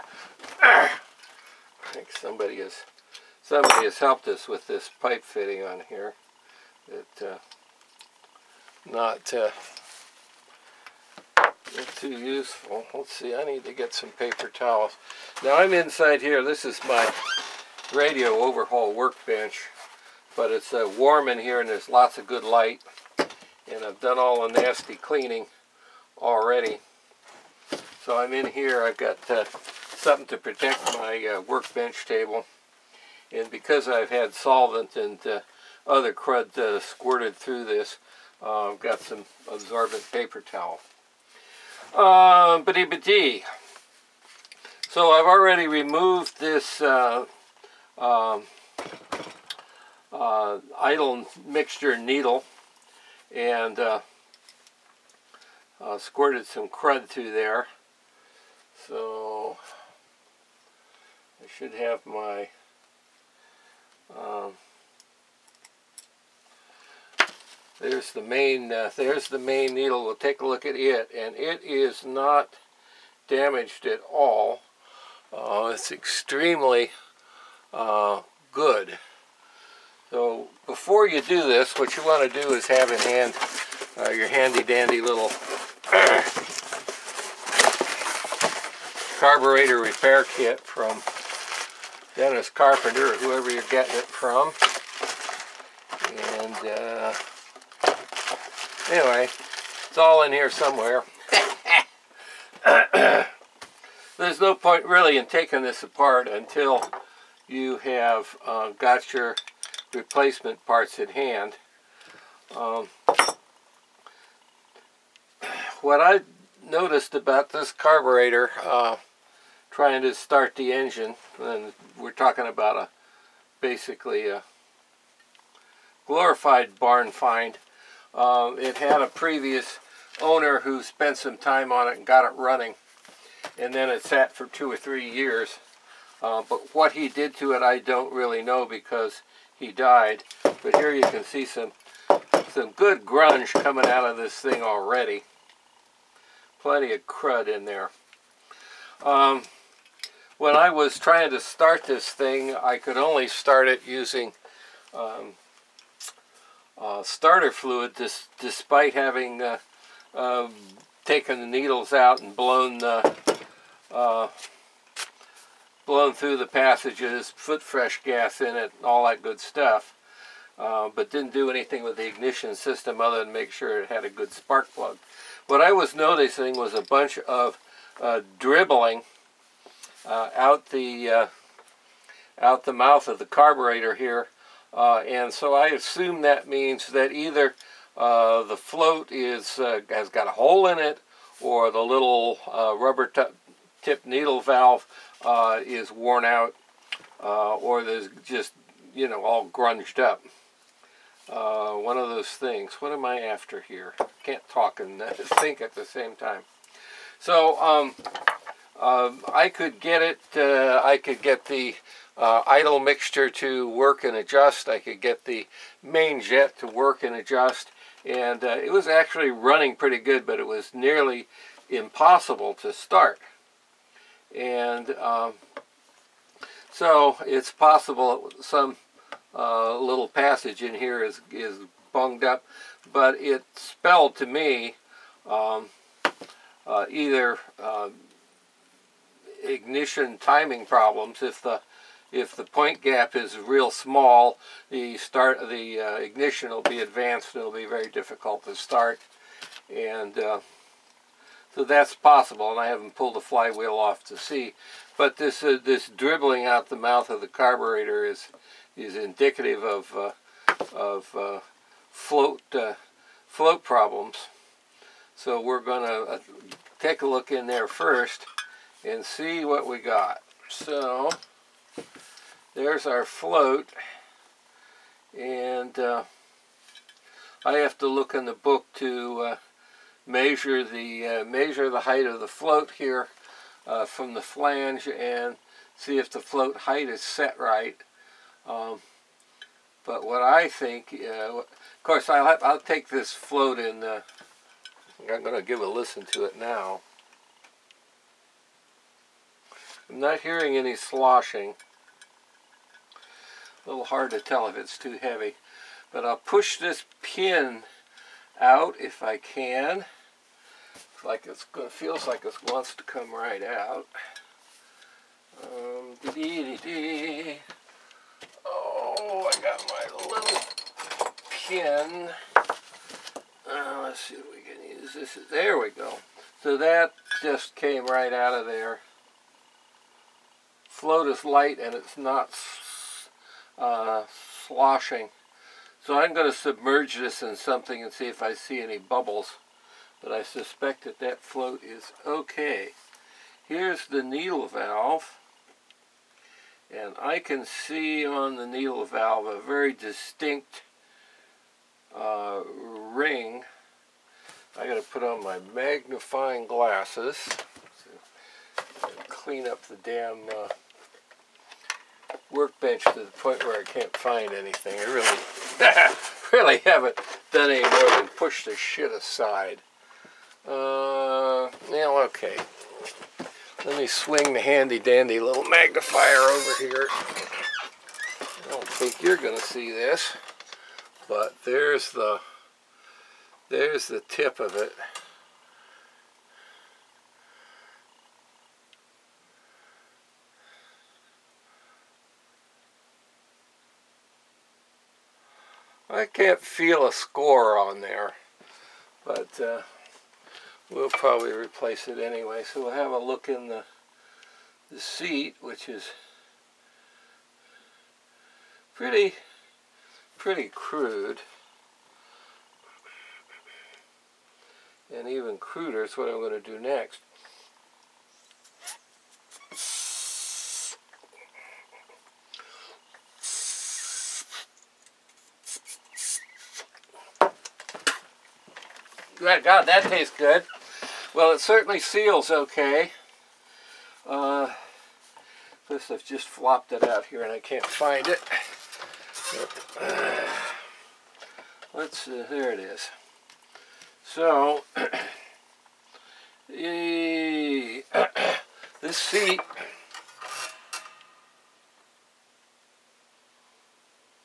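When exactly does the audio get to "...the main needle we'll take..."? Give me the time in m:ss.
1:09.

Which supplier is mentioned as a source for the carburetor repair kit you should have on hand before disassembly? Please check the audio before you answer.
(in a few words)
Dennis Carpenter.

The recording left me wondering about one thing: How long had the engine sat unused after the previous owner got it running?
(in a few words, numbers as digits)
two or three years.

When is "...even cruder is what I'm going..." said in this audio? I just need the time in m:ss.
6:55.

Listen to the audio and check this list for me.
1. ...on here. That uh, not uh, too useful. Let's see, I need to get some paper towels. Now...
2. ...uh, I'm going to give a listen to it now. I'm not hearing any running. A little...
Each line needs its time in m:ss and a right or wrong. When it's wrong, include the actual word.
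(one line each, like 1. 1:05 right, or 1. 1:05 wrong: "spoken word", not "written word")
1. 0:05 right
2. 4:53 wrong: "sloshing", not "running".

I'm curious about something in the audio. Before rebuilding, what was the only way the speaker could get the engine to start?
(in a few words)
starter fluid.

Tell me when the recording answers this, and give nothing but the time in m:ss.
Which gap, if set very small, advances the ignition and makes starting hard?
4:02.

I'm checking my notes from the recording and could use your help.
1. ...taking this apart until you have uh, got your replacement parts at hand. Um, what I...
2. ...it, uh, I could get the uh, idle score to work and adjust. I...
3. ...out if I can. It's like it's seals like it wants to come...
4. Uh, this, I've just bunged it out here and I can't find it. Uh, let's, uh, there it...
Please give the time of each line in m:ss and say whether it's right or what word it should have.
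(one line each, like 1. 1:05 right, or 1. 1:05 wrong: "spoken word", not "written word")
1. 1:45 right
2. 3:30 wrong: "mixture", not "score"
3. 5:08 wrong: "feels", not "seals"
4. 7:14 wrong: "flopped", not "bunged".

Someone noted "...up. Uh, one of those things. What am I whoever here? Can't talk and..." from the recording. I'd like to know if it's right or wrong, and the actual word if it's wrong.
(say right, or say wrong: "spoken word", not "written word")
wrong: "after", not "whoever".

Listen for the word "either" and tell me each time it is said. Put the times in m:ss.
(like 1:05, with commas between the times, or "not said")
3:07, 3:56.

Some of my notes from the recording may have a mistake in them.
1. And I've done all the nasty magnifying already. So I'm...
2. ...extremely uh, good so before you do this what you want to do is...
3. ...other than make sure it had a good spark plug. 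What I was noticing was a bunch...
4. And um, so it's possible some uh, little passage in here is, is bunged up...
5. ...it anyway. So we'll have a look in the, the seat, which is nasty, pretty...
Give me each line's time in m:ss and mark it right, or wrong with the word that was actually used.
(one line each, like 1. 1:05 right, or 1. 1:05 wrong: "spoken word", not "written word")
1. 0:23 wrong: "cleaning", not "magnifying"
2. 1:15 right
3. 2:52 right
4. 3:44 right
5. 6:41 wrong: "pretty", not "nasty".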